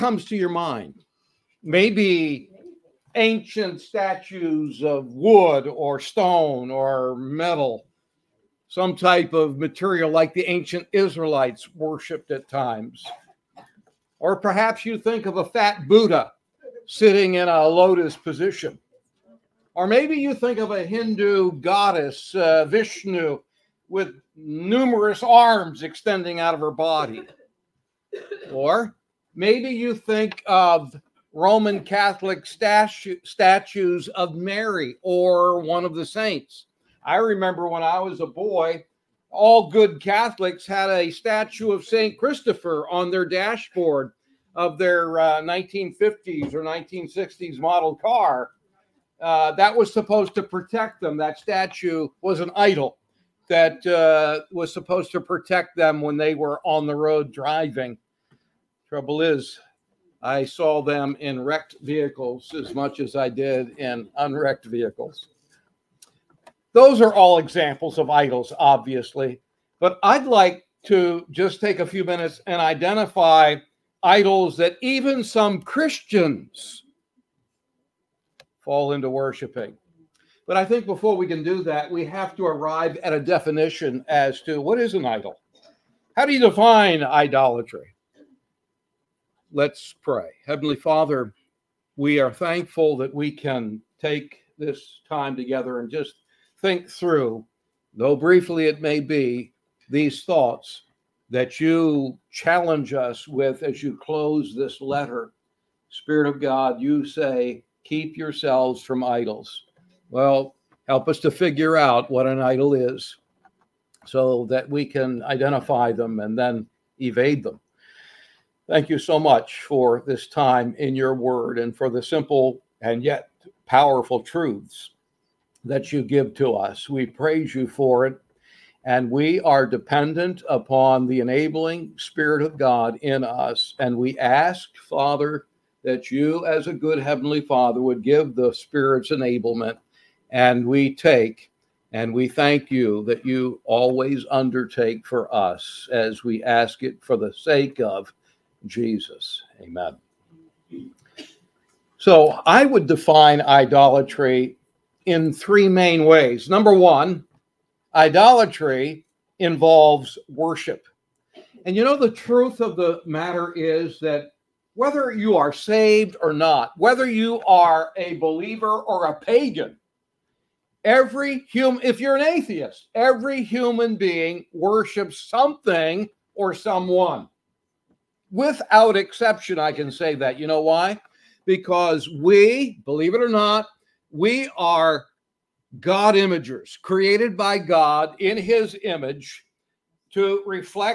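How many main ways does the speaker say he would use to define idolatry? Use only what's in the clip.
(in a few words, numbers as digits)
3.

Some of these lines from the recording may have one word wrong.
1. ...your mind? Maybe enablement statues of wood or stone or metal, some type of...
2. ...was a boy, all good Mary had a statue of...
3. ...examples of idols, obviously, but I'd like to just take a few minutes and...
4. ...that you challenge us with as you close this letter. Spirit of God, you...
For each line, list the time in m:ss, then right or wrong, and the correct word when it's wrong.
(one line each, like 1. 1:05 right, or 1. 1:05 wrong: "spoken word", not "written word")
1. 0:00 wrong: "ancient", not "enablement"
2. 0:37 wrong: "Catholics", not "Mary"
3. 1:07 right
4. 1:41 right.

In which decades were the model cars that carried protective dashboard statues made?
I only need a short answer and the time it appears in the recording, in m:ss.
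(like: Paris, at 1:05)
1950s or 1960s, at 0:45.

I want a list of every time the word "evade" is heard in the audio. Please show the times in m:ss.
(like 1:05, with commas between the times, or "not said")
1:57.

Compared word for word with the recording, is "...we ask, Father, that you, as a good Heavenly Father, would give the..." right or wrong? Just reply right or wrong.
right.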